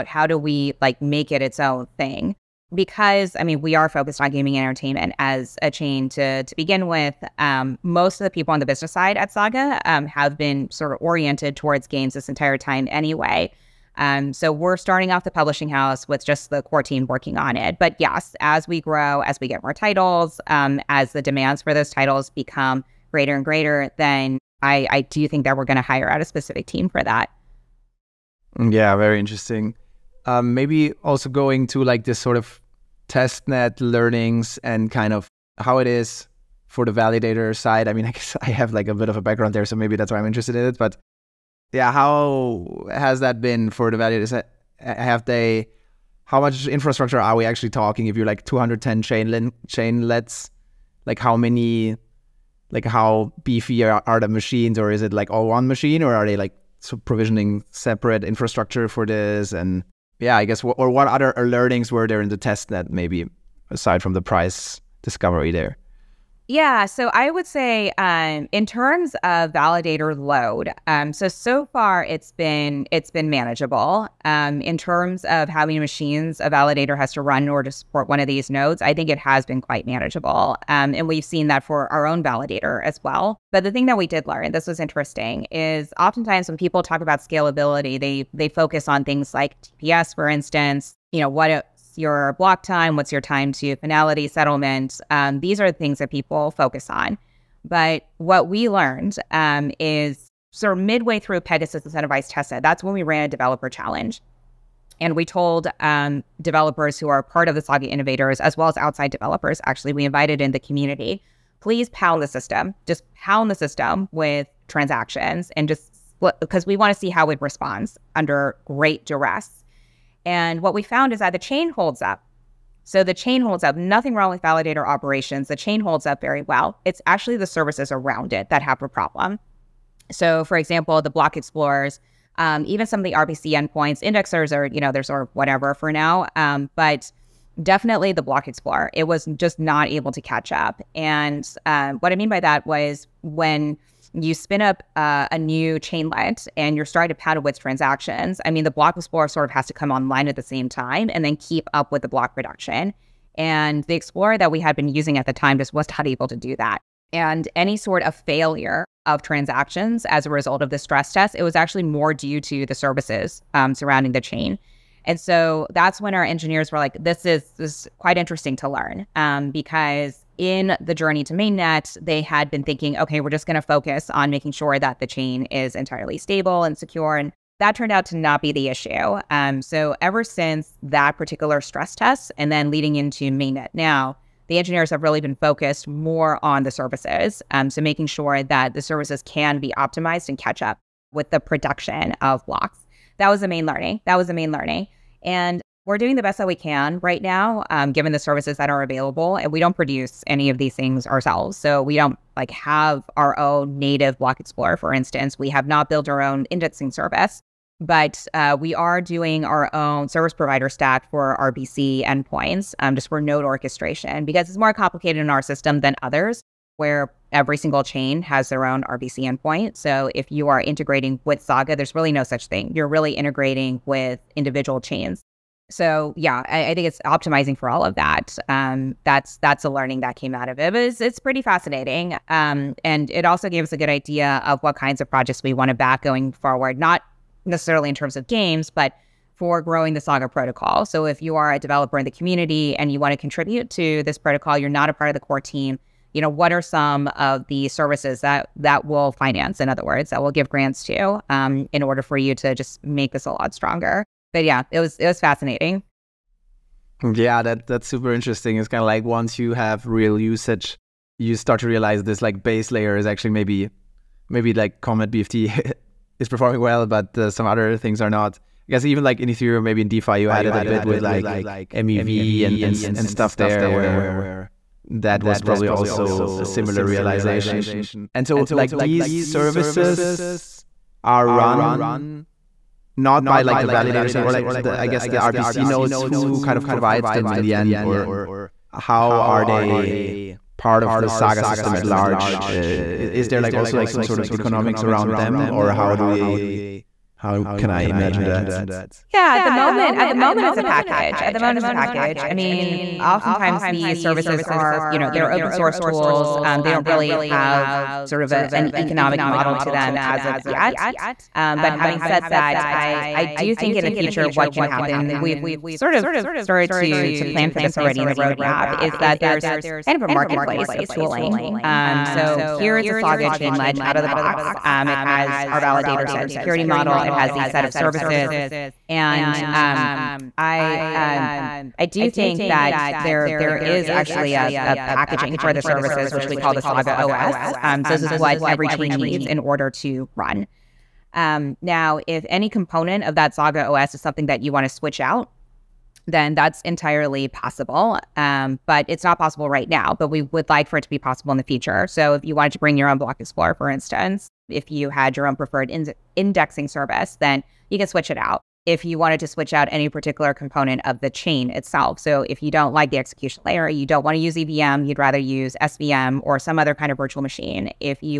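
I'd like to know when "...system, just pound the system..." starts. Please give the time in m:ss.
1:52.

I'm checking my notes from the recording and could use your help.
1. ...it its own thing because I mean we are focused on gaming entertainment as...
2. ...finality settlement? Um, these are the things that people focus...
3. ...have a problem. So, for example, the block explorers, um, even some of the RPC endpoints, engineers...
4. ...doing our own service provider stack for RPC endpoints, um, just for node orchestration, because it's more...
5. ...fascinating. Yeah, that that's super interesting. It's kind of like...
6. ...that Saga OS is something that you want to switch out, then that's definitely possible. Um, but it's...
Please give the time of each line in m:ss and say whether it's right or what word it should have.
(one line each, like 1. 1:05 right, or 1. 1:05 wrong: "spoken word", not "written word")
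1. 0:01 right
2. 1:33 right
3. 2:08 wrong: "indexers", not "engineers"
4. 3:28 right
5. 4:15 right
6. 5:43 wrong: "entirely", not "definitely".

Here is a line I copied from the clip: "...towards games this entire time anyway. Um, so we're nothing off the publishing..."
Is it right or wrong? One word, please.
wrong.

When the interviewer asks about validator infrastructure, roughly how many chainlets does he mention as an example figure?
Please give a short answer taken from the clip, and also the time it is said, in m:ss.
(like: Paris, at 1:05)
210, at 0:48.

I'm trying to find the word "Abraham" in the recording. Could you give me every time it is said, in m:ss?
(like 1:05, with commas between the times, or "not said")
not said.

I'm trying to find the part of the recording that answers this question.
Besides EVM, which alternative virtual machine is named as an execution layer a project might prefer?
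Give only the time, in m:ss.
6:05.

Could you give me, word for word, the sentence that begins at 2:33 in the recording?
And the explorer that we had been using at the time just was not able to do that.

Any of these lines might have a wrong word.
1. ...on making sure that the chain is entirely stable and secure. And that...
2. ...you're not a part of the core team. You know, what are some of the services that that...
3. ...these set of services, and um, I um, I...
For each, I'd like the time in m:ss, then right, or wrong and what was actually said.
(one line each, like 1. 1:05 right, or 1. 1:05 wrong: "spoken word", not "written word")
1. 2:54 right
2. 4:04 right
3. 5:27 right.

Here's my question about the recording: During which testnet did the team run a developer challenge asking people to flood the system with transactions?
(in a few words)
Pegasus Incentivized Testnet.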